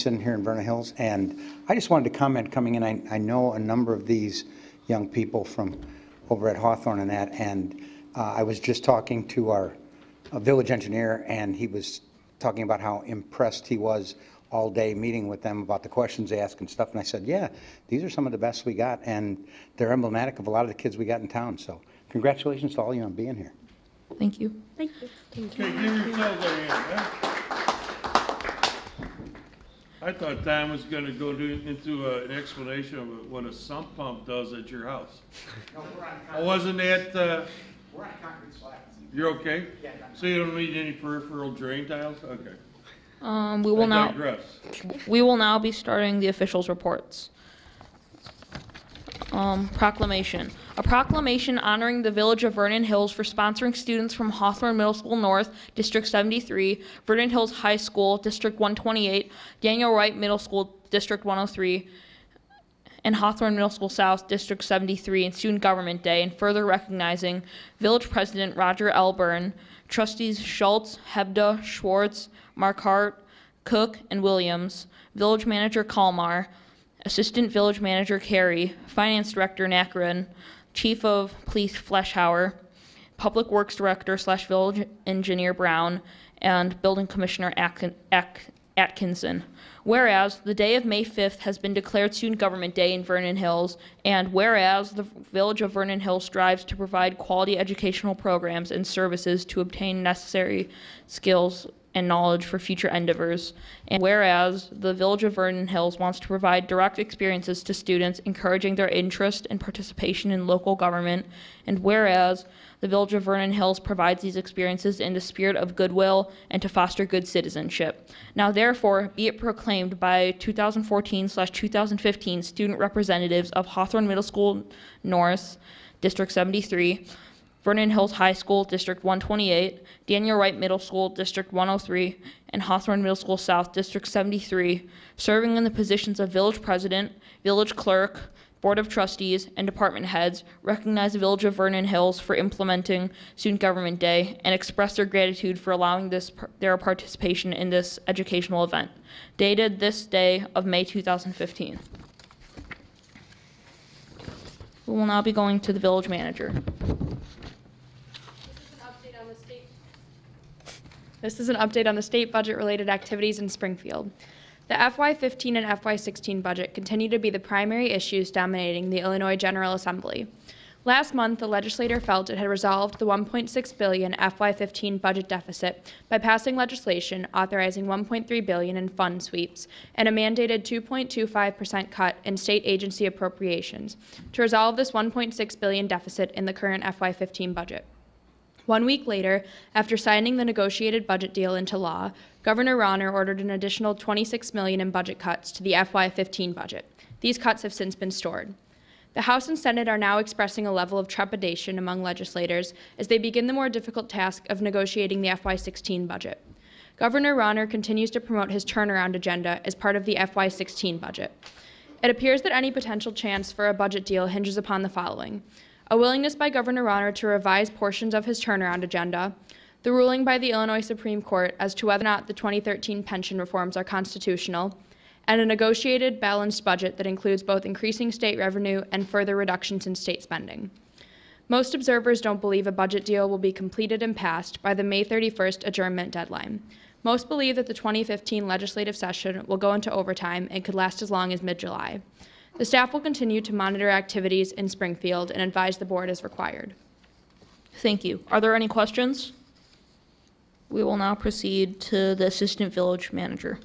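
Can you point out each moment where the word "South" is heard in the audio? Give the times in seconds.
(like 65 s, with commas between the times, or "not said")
63 s, 133 s.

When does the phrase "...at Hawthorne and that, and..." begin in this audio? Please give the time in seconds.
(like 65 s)
6 s.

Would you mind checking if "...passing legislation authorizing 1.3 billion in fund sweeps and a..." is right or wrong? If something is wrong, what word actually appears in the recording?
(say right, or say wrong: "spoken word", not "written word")
right.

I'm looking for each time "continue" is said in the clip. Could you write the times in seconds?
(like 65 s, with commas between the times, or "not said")
166 s, 207 s, 242 s.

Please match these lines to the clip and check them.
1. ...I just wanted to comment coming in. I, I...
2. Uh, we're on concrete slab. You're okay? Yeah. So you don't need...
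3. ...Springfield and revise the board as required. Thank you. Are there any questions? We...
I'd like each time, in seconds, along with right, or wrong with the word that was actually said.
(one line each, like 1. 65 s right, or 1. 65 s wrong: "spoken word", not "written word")
1. 1 s right
2. 37 s right
3. 244 s wrong: "advise", not "revise".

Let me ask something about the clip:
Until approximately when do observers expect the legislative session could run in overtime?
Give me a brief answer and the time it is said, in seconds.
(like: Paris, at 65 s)
mid July, at 241 s.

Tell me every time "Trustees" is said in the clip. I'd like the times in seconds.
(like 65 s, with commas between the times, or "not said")
69 s, 138 s.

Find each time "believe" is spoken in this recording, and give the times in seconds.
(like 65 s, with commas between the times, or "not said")
232 s, 237 s.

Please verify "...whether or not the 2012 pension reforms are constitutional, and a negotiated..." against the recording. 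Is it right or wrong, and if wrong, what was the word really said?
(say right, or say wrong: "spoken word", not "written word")
wrong: "2013", not "2012".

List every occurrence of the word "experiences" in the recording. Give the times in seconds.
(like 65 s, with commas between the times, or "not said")
106 s, 114 s.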